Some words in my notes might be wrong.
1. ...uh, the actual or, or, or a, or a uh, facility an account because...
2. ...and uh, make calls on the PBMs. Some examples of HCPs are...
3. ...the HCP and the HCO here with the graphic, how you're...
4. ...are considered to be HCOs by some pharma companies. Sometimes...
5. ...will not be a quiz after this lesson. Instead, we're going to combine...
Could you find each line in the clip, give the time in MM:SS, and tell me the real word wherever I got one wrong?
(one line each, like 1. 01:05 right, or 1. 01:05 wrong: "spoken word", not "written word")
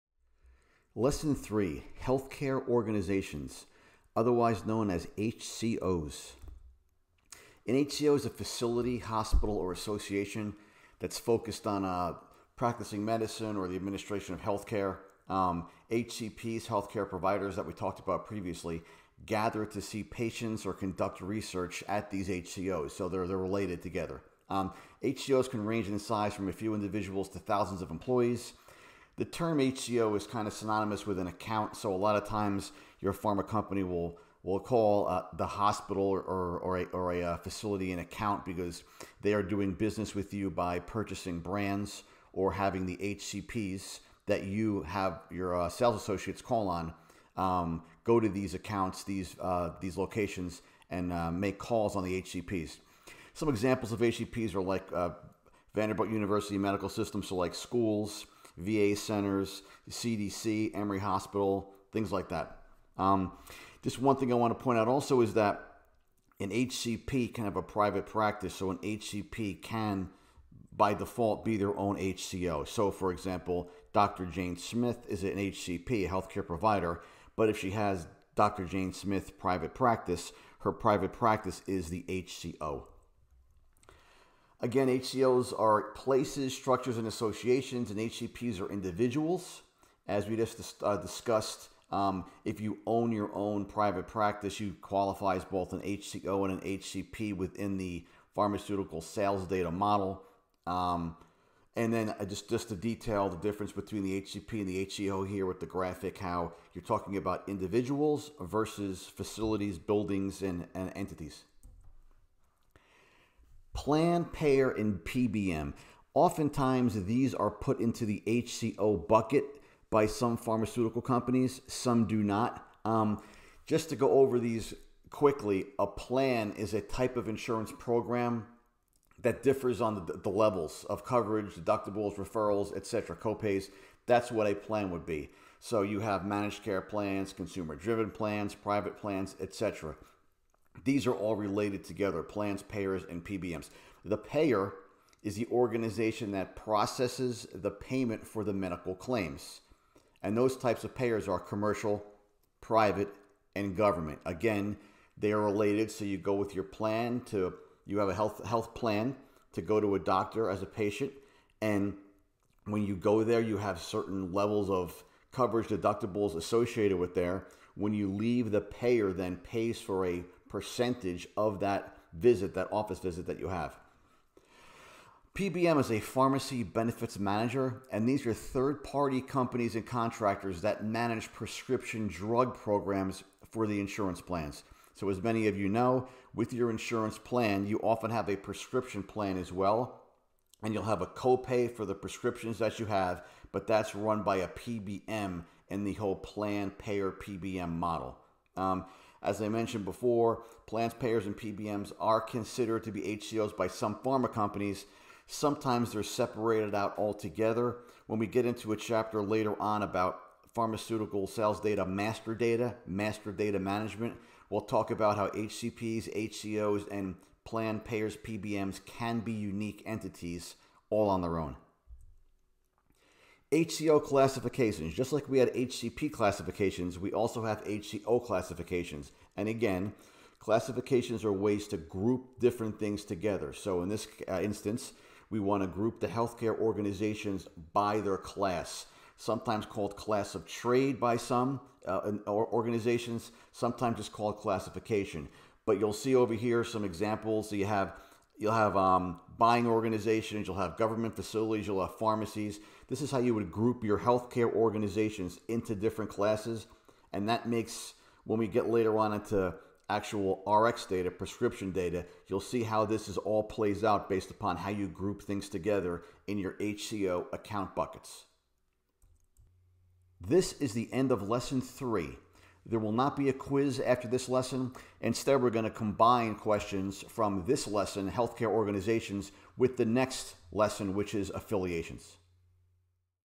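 1. 00:35 wrong: "hospital", not "actual"
2. 00:50 wrong: "HCPs", not "PBMs"
3. 01:44 right
4. 03:21 right
5. 04:32 right.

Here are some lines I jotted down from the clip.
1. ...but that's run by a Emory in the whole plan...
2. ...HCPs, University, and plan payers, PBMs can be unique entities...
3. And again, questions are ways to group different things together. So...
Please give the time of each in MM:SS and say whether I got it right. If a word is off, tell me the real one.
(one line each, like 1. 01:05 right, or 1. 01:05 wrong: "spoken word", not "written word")
1. 03:13 wrong: "PBM", not "Emory"
2. 03:35 wrong: "HCOs", not "University"
3. 03:49 wrong: "classifications", not "questions".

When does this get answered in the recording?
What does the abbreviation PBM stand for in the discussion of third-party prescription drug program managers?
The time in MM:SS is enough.
02:56.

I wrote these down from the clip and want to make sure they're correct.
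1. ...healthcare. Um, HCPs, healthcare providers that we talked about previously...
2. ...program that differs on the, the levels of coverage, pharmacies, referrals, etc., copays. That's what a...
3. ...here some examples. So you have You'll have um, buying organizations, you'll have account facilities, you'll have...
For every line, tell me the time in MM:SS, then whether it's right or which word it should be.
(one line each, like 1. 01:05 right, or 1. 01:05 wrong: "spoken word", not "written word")
1. 00:14 right
2. 02:07 wrong: "deductibles", not "pharmacies"
3. 04:06 wrong: "government", not "account".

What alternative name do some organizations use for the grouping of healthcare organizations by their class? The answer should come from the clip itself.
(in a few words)
Class of trade.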